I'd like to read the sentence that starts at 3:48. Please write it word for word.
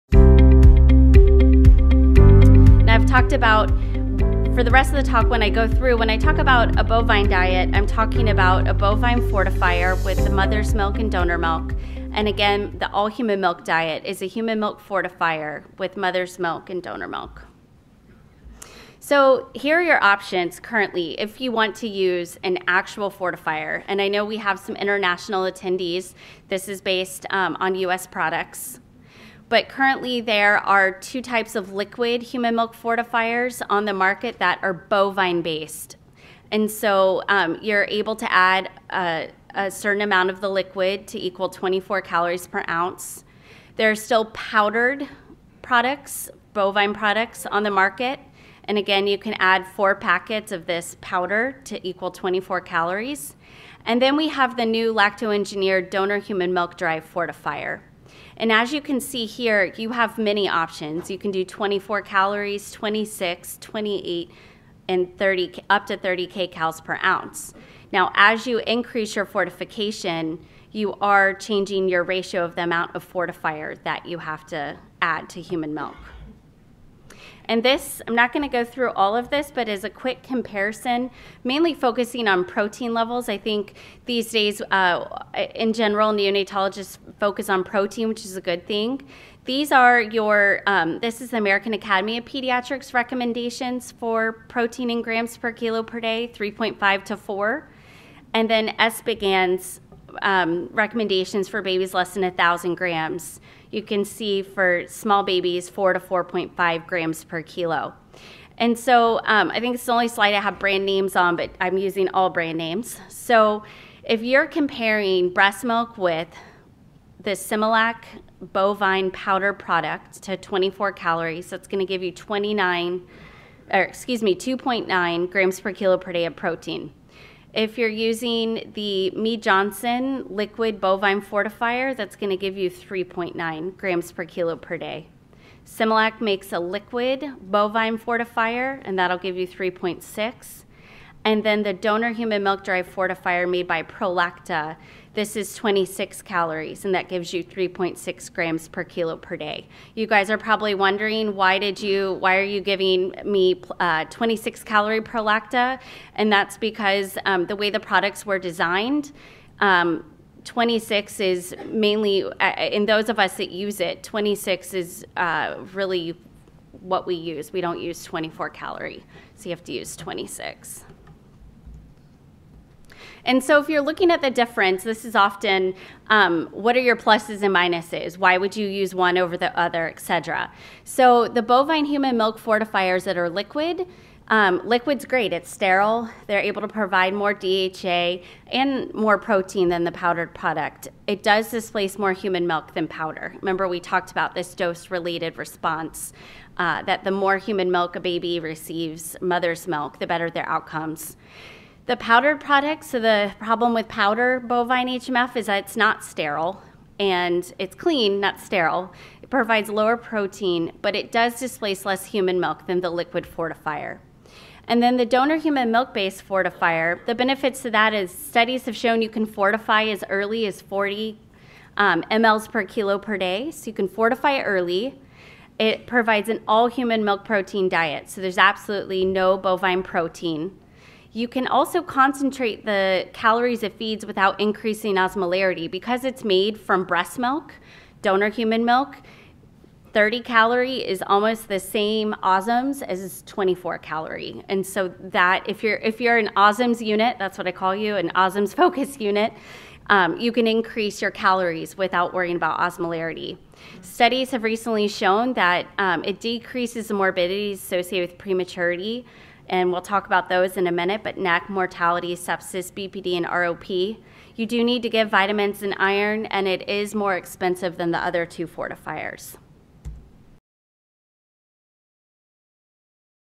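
So there's absolutely no bovine protein.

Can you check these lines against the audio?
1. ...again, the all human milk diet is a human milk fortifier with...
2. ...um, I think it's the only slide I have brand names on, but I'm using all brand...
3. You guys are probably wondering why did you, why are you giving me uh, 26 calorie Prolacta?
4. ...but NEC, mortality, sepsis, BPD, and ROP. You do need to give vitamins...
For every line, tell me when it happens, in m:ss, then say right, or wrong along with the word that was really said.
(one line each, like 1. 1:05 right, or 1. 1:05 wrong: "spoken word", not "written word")
1. 0:12 right
2. 1:49 right
3. 2:29 right
4. 4:21 right.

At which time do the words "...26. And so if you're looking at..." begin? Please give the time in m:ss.
2:49.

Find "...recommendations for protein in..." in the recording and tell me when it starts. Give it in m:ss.
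1:32.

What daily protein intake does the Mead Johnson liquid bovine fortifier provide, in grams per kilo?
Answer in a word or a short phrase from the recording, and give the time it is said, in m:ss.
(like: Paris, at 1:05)
3.9, at 2:12.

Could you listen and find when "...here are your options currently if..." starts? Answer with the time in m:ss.
0:19.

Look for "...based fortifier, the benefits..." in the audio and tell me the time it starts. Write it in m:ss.
3:35.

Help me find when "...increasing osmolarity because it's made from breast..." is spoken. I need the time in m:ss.
3:54.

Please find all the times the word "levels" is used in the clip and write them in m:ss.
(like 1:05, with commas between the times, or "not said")
1:22.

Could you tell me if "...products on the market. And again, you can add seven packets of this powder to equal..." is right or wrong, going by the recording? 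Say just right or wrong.
wrong.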